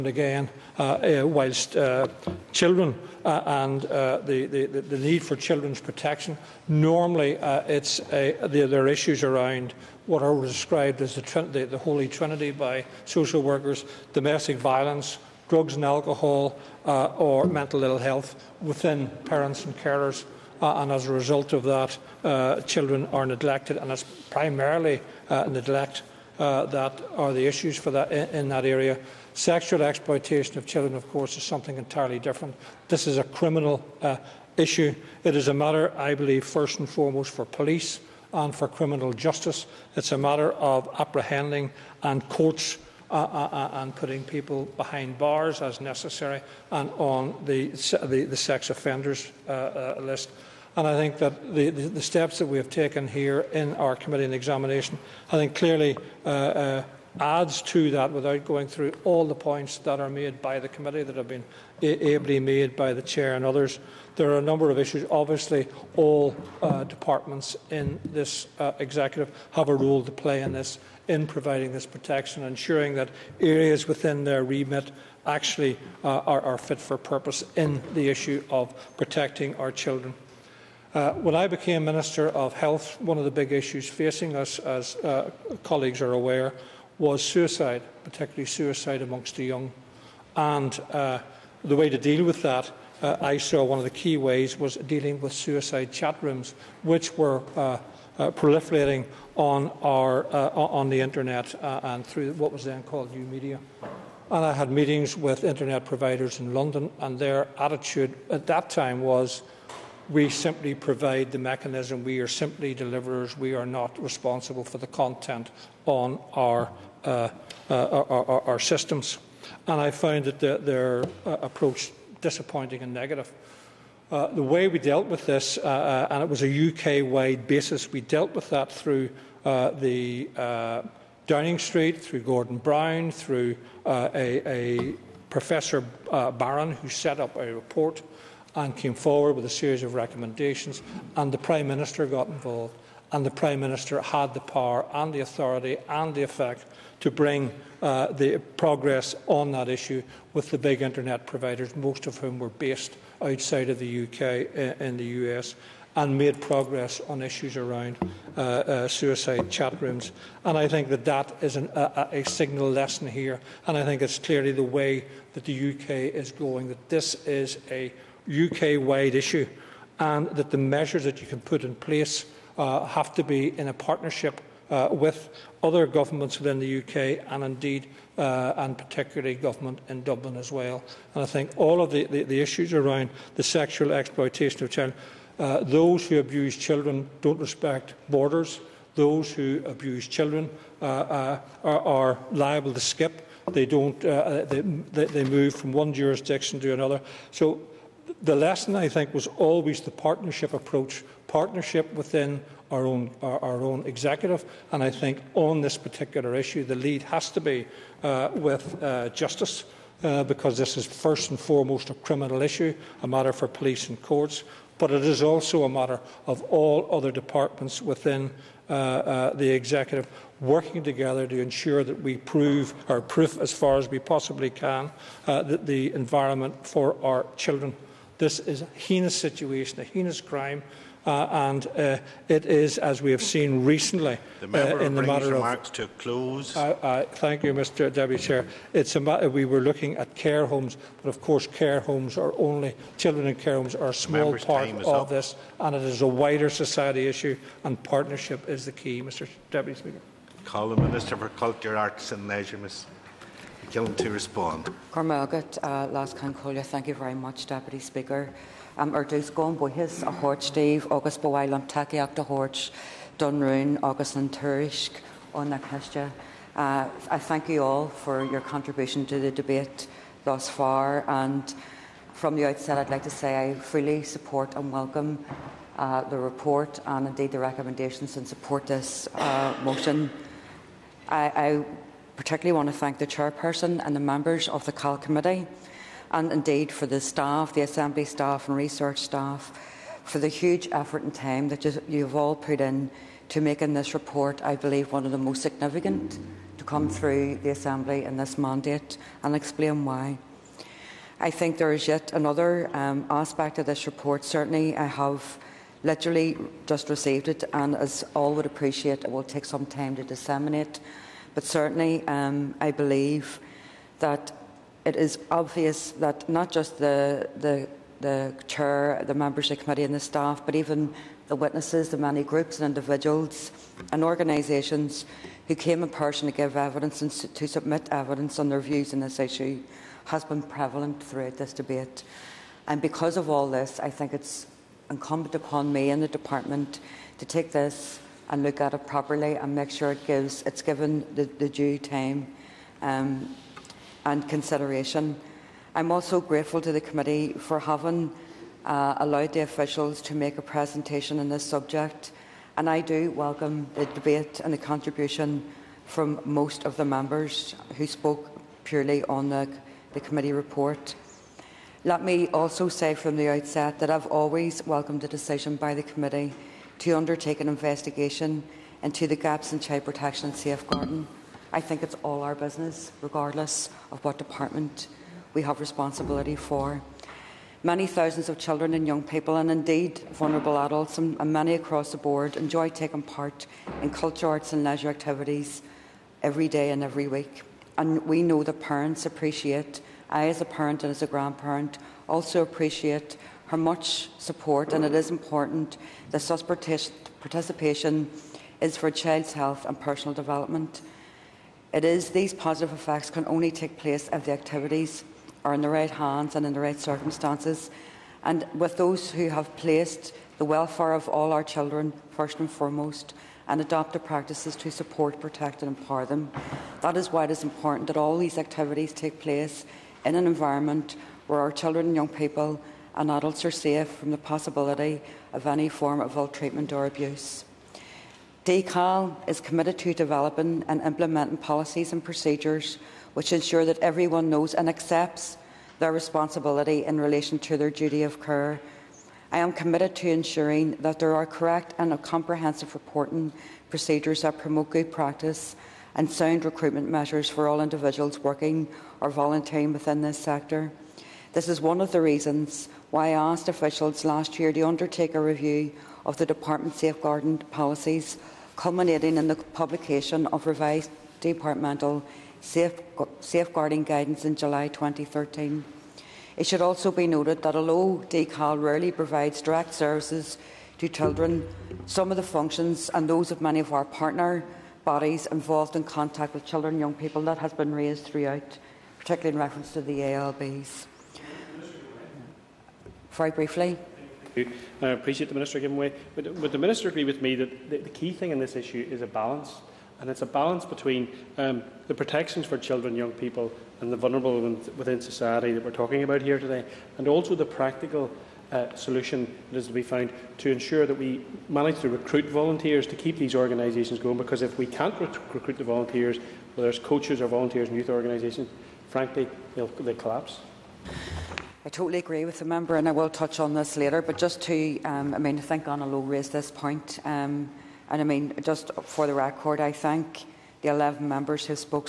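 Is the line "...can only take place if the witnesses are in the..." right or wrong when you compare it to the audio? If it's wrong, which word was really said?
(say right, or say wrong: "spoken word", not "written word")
wrong: "activities", not "witnesses".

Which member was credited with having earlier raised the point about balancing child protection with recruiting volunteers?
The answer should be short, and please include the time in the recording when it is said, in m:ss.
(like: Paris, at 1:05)
Anna Lo, at 8:35.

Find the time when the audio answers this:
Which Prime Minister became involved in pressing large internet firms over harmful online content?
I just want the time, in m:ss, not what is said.
2:12.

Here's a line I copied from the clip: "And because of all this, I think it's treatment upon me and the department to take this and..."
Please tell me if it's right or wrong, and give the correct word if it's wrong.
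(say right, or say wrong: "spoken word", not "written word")
wrong: "incumbent", not "treatment".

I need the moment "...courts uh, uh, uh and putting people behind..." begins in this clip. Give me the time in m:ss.
0:42.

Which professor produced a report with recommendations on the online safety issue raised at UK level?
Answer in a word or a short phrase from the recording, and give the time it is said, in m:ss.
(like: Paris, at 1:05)
Professor Byron, at 2:15.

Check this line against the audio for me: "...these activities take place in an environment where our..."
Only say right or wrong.
right.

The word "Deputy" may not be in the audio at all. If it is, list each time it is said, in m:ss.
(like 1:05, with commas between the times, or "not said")
3:57, 4:09, 4:17.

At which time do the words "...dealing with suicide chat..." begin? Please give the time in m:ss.
1:34.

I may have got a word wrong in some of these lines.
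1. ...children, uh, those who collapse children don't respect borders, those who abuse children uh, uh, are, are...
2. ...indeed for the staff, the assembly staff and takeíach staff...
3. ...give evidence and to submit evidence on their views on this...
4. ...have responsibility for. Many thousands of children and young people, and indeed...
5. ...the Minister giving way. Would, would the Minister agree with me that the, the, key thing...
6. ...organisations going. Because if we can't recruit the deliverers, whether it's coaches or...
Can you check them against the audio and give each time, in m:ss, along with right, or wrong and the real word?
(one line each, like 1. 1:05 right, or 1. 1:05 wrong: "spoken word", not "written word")
1. 3:04 wrong: "abuse", not "collapse"
2. 4:46 wrong: "research", not "takeíach"
3. 5:26 right
4. 6:15 right
5. 8:05 right
6. 8:23 wrong: "volunteers", not "deliverers".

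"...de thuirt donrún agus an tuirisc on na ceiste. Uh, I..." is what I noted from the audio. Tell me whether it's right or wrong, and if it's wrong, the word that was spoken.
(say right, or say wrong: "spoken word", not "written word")
right.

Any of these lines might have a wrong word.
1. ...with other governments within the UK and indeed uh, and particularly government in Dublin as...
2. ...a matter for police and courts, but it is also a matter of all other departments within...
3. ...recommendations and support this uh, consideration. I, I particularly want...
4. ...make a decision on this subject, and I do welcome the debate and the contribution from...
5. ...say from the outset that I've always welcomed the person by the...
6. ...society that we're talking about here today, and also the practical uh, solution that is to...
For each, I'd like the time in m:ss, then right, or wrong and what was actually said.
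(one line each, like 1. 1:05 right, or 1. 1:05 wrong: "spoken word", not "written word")
1. 2:54 right
2. 3:33 right
3. 4:37 wrong: "motion", not "consideration"
4. 5:50 wrong: "presentation", not "decision"
5. 6:02 wrong: "decision", not "person"
6. 8:14 right.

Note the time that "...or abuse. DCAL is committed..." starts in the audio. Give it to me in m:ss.
7:06.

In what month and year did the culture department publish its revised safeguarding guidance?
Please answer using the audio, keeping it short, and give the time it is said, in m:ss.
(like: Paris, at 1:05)
July 2013, at 7:44.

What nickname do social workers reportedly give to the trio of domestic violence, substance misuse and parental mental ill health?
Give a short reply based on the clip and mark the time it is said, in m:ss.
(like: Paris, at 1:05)
the Holy Trinity, at 0:11.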